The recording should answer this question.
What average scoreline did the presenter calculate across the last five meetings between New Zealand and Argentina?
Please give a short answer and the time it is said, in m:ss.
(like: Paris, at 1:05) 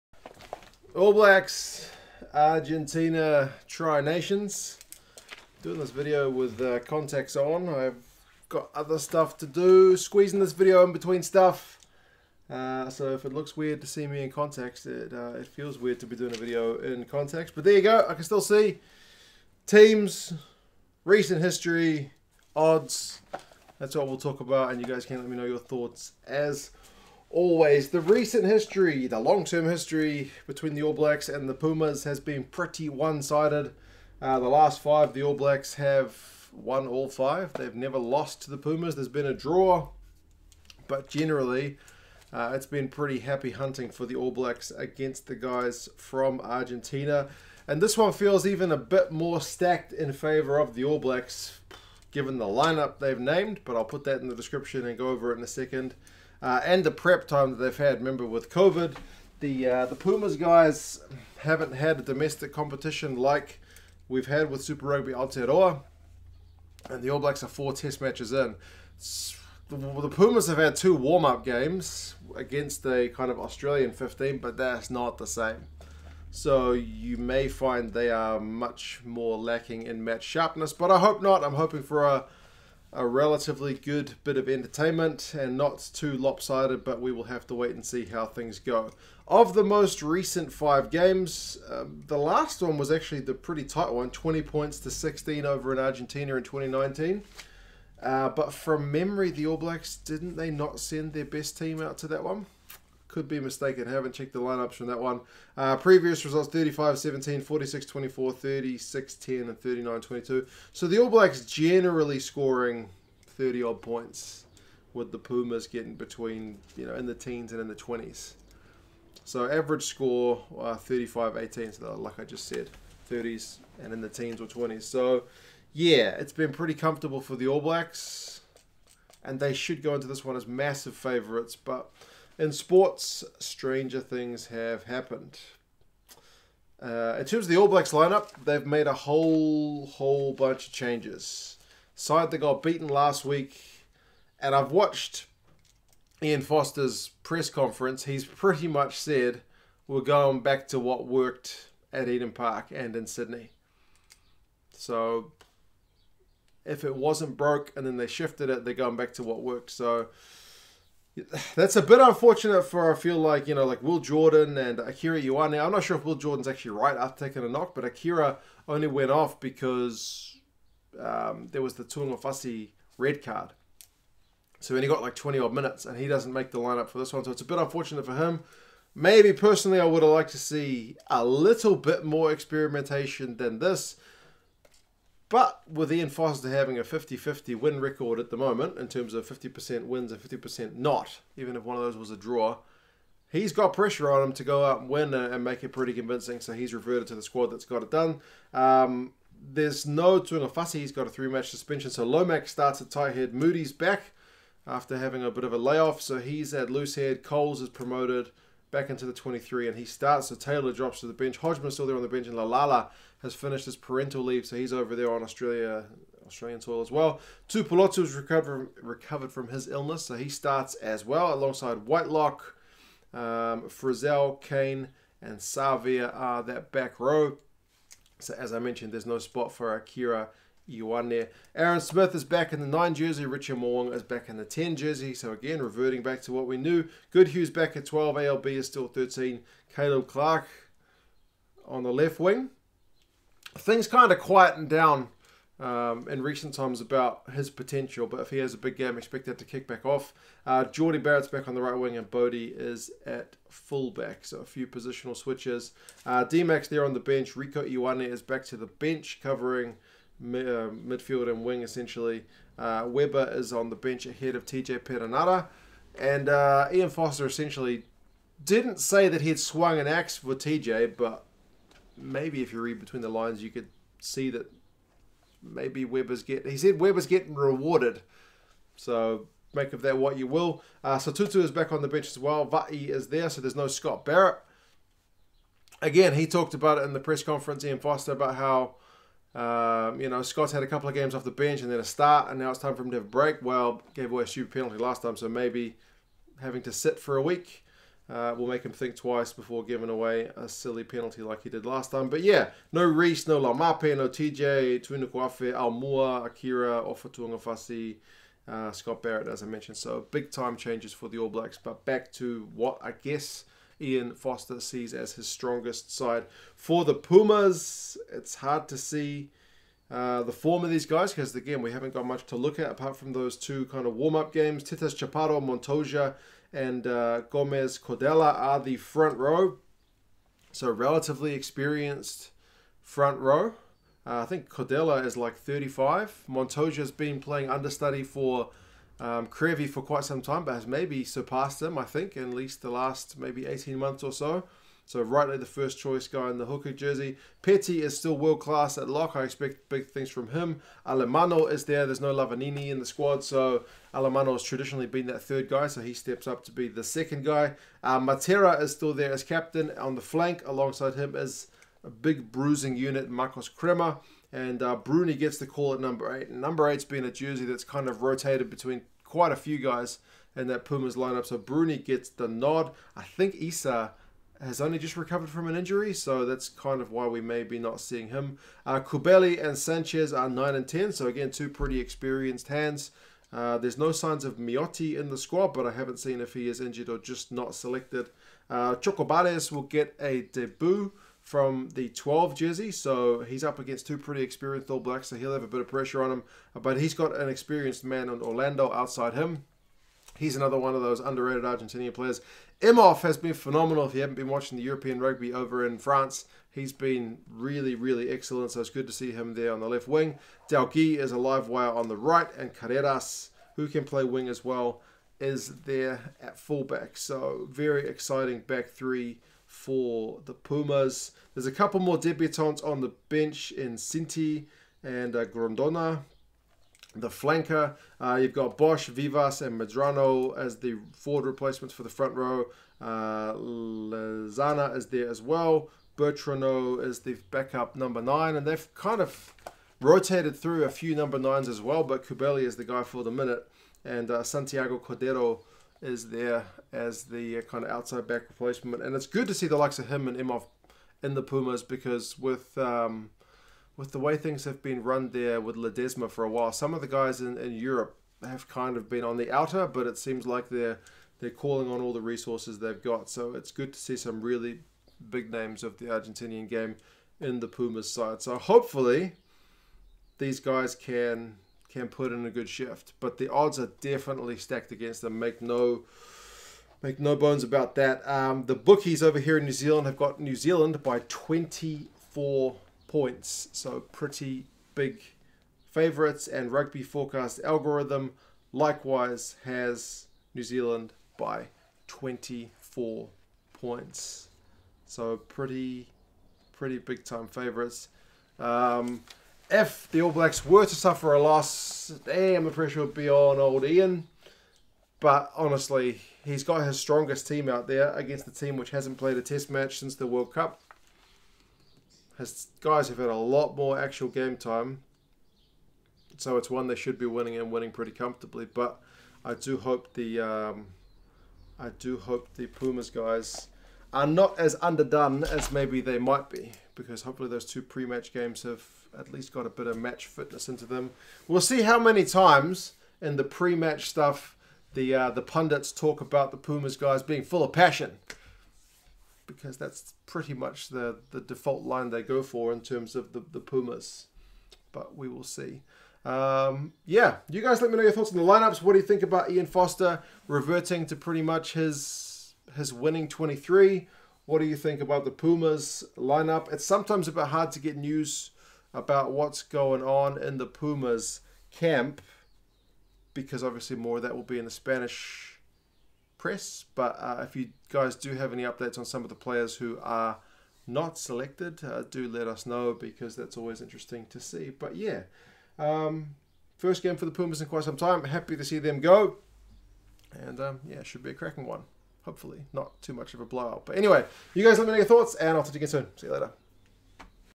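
35-18, at 2:00.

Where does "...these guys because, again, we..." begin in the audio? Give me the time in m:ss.
5:20.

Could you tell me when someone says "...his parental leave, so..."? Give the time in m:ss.
3:33.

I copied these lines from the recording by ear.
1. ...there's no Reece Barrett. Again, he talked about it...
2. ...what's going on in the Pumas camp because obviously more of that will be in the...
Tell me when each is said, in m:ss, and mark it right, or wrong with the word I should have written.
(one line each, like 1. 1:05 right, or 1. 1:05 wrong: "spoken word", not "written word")
1. 4:43 wrong: "Scott", not "Reece"
2. 9:19 right.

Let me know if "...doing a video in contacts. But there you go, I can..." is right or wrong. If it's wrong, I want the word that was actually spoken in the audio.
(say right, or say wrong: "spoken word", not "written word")
right.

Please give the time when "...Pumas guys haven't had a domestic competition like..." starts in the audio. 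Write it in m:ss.
0:59.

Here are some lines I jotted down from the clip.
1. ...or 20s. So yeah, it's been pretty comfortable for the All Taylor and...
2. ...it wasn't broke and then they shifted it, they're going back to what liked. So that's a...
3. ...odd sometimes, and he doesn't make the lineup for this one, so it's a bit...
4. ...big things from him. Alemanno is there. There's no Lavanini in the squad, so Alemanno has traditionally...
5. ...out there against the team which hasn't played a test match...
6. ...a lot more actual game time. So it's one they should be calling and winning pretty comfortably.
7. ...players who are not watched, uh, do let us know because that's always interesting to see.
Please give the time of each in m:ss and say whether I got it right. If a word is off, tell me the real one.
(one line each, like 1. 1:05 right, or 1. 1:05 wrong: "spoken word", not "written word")
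1. 2:04 wrong: "Blacks", not "Taylor"
2. 2:36 wrong: "worked", not "liked"
3. 2:55 wrong: "minutes", not "sometimes"
4. 5:49 right
5. 8:27 right
6. 8:33 wrong: "winning", not "calling"
7. 9:29 wrong: "selected", not "watched".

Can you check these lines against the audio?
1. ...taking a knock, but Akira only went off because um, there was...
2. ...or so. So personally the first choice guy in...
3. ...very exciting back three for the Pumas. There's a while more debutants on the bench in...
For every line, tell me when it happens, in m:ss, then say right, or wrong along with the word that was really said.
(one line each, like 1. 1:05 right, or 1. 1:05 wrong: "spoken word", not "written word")
1. 2:47 right
2. 5:44 wrong: "rightly", not "personally"
3. 6:57 wrong: "couple", not "while".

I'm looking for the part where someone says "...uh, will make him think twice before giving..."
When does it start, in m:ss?
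4:58.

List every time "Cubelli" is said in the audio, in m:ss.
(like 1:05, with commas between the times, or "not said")
6:18, 7:22.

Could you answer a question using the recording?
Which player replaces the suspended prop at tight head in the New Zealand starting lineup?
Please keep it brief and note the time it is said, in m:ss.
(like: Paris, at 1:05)
Lomax, at 3:22.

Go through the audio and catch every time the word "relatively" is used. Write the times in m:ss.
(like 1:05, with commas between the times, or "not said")
1:23, 5:30.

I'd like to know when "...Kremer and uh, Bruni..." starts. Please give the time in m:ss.
6:03.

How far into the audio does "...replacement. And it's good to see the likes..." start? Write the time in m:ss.
7:28.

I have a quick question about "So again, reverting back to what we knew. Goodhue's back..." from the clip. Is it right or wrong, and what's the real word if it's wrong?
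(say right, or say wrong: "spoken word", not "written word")
right.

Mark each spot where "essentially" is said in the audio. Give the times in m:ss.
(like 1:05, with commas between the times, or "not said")
4:21, 4:27.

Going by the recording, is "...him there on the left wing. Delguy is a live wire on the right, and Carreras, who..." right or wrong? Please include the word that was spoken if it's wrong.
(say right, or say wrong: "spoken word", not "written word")
right.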